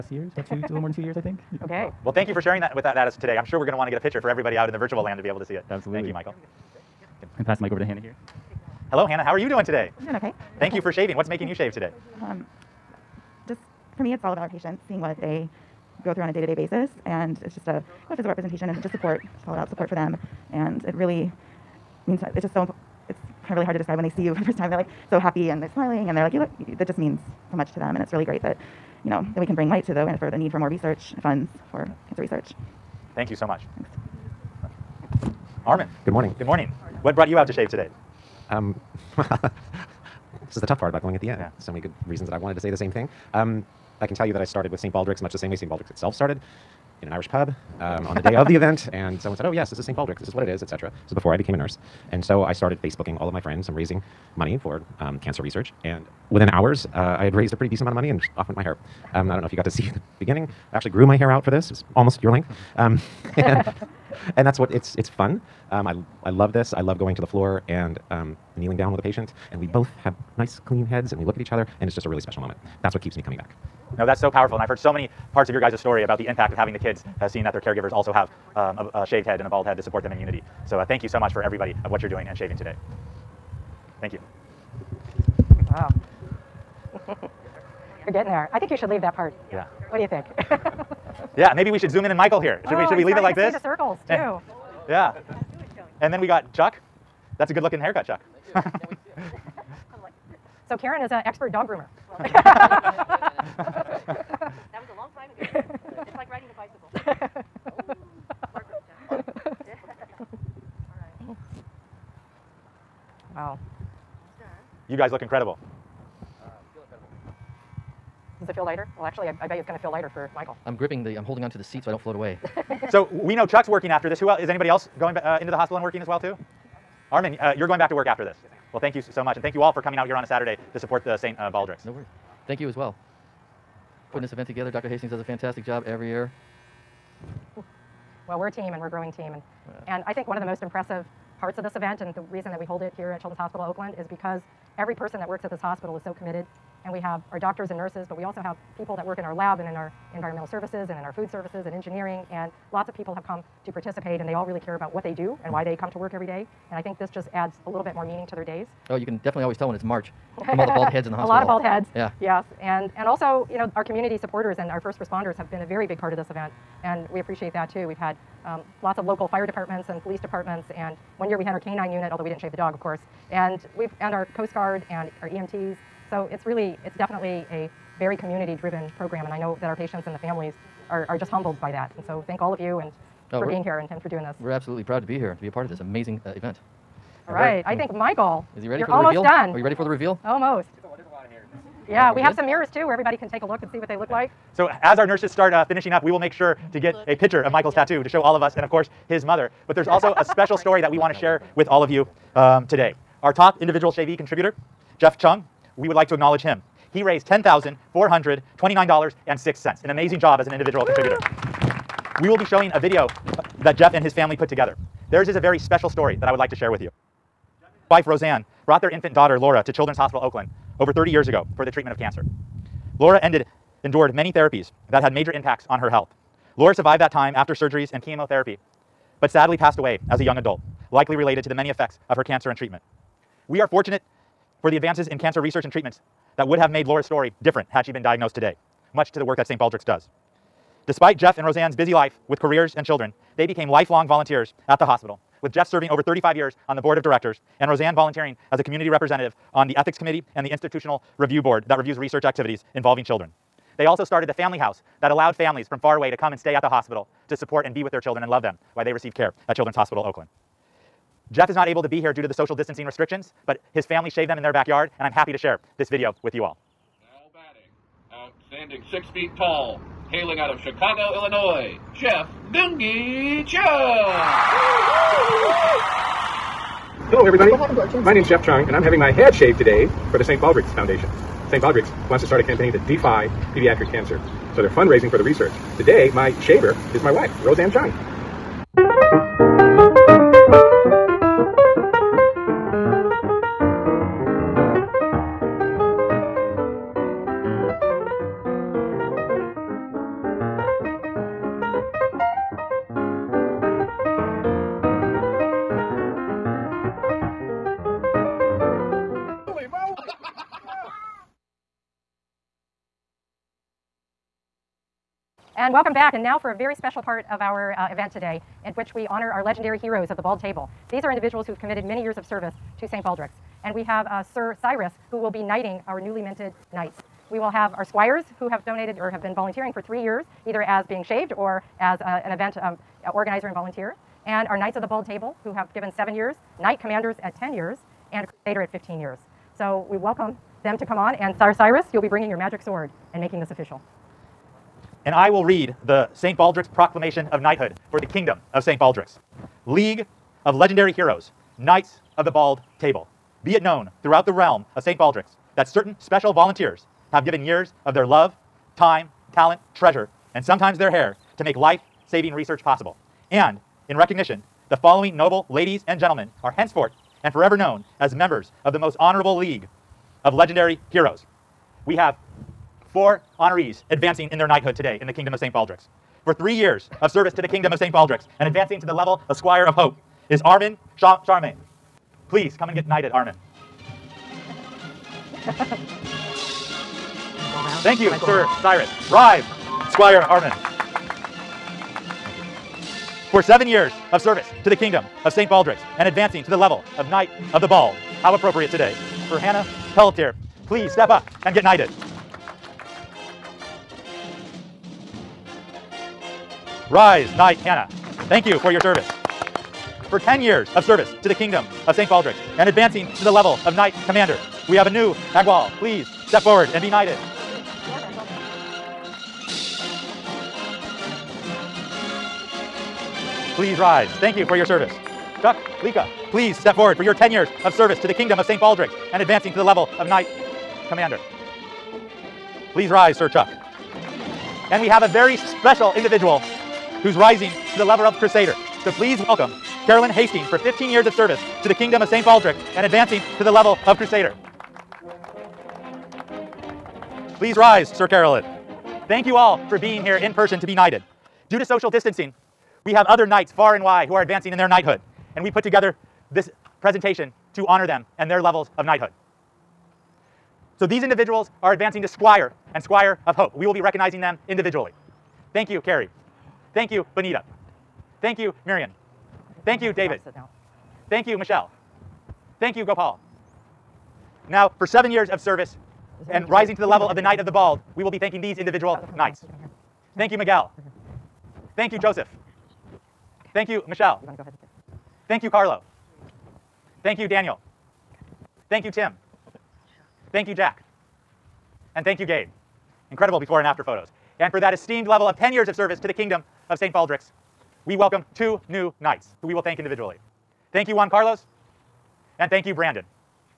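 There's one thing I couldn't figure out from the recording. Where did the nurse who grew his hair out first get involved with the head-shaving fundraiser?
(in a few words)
An Irish pub.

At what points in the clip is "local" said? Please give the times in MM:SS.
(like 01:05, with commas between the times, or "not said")
02:49.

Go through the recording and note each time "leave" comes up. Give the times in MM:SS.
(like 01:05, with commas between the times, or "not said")
01:28, 01:33.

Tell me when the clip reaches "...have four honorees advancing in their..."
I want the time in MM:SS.
06:11.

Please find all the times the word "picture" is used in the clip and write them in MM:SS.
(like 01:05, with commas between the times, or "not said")
00:03, 03:17.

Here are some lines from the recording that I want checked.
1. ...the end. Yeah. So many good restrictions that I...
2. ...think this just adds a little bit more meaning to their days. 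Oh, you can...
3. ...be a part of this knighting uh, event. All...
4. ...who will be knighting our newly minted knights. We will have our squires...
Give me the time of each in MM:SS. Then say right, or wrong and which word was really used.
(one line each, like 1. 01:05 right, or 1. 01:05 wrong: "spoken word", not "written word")
1. 00:41 wrong: "reasons", not "restrictions"
2. 02:36 right
3. 03:05 wrong: "amazing", not "knighting"
4. 05:25 right.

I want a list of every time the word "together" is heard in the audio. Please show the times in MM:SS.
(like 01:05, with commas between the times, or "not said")
02:14, 03:34, 07:35.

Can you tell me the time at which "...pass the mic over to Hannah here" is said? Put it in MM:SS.
00:07.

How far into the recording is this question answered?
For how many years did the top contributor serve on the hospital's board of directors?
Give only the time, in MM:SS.
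04:06.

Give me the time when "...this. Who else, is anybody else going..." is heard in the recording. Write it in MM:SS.
02:04.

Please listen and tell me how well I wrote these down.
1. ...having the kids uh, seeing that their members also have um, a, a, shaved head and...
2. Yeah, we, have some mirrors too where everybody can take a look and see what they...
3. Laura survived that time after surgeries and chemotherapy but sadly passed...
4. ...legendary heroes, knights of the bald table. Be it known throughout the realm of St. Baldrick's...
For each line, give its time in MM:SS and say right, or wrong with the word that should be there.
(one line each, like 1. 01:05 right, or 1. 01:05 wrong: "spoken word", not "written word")
1. 01:16 wrong: "caregivers", not "members"
2. 03:11 right
3. 03:46 right
4. 05:50 right.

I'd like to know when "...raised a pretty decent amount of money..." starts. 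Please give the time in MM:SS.
00:57.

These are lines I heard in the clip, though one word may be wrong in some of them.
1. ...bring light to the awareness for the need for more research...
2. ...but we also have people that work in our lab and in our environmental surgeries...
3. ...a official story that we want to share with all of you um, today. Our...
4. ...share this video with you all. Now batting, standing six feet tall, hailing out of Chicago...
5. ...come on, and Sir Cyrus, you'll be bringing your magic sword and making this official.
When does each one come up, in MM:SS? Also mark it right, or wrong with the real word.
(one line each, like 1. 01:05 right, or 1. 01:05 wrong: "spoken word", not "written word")
1. 00:29 right
2. 02:28 wrong: "services", not "surgeries"
3. 03:20 wrong: "special", not "official"
4. 04:25 right
5. 05:40 right.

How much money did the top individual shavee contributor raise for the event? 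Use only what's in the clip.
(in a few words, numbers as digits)
$10,429.06.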